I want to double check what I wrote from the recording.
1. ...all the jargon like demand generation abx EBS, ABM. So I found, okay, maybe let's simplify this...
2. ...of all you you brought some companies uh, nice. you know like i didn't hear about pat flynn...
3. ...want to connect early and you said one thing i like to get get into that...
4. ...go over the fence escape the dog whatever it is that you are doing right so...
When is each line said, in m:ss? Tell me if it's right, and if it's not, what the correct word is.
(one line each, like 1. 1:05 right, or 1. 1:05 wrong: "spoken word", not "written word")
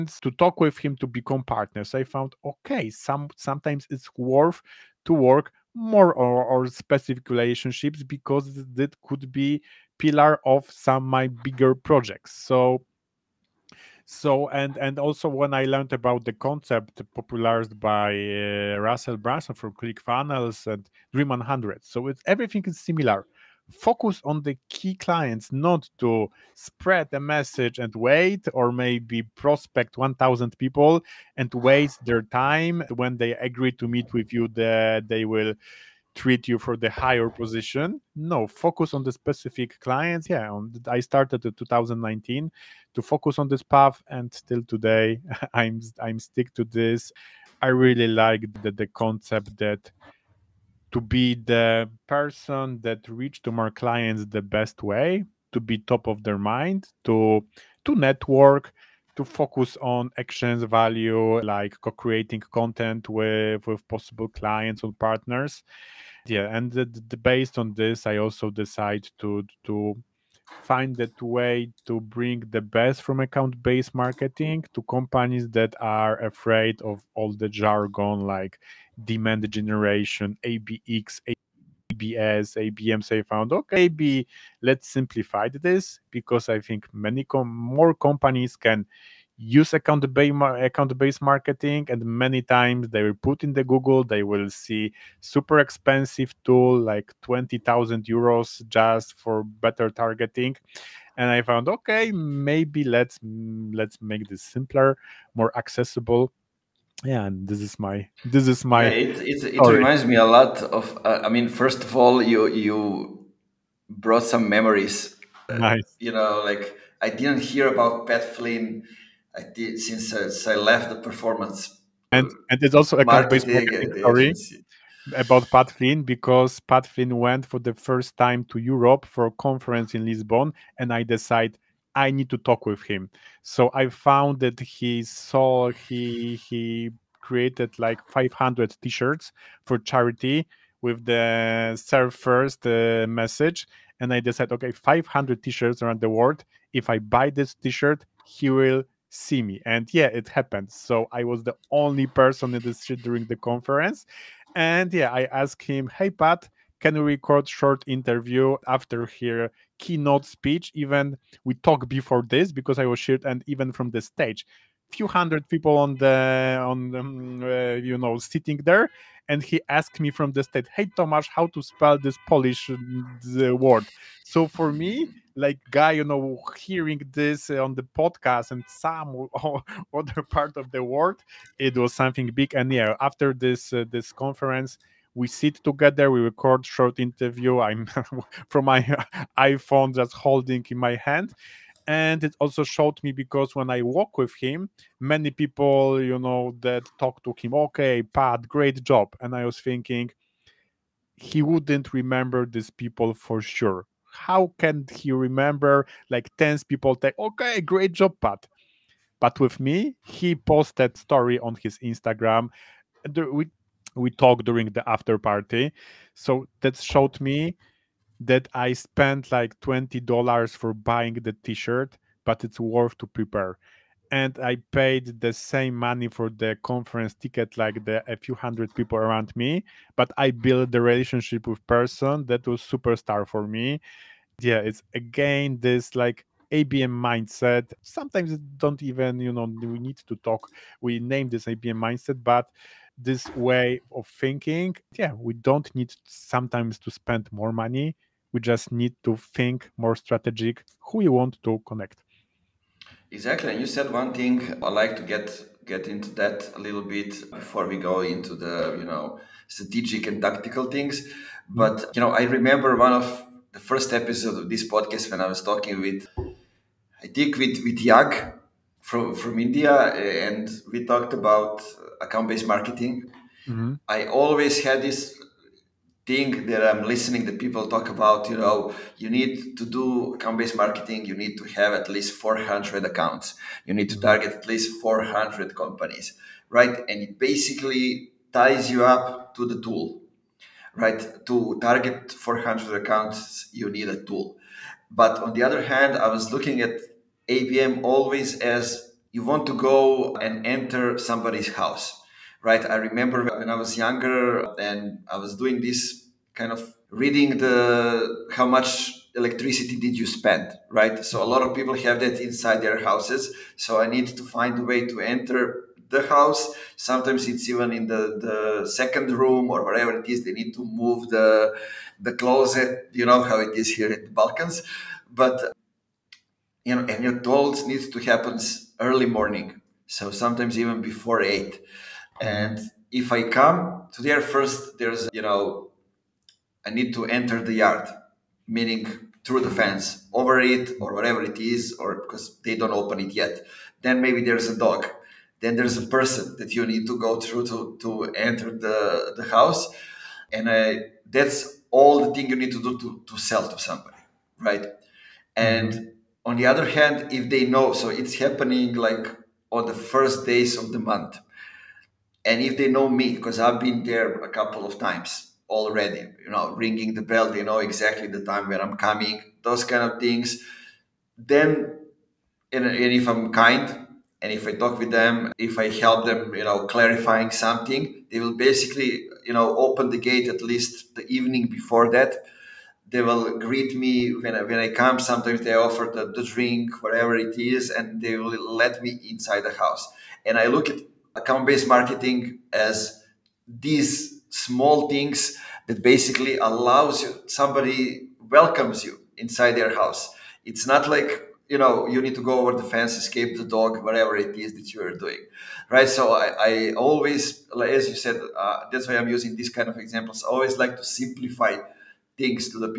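1. 1:17 right
2. 1:51 wrong: "memories", not "companies"
3. 4:11 wrong: "exactly", not "early"
4. 6:42 right.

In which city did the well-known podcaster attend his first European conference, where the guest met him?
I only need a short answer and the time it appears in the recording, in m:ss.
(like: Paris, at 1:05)
Lisbon, at 2:10.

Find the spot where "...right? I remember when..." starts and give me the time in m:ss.
5:02.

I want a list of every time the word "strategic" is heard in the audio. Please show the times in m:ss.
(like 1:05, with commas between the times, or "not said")
4:09, 4:19.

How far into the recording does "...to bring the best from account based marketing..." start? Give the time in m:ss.
1:11.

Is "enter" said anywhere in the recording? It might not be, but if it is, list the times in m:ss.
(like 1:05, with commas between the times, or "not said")
5:00, 5:15, 5:37, 5:48.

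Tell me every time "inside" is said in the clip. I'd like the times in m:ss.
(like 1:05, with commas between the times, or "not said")
5:12, 6:29, 6:39.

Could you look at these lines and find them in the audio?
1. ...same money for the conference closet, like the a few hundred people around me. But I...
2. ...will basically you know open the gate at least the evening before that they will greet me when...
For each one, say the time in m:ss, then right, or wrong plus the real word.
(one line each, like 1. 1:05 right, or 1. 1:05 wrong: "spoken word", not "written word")
1. 3:45 wrong: "ticket", not "closet"
2. 6:18 right.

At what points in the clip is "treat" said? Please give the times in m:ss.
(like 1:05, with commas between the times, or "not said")
0:36.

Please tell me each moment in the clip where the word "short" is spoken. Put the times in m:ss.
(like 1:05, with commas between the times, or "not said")
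2:37, 3:06.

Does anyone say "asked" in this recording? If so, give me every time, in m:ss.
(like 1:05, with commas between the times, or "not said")
2:35, 2:49.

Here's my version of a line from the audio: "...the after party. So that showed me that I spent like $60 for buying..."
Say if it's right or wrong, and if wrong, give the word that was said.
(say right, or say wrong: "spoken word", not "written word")
wrong: "20", not "60".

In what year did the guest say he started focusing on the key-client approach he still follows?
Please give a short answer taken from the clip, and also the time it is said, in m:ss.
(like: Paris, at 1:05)
2019, at 0:41.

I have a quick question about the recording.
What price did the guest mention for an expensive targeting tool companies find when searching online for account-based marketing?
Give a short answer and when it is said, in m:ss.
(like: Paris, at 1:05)
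20000 euros, at 1:37.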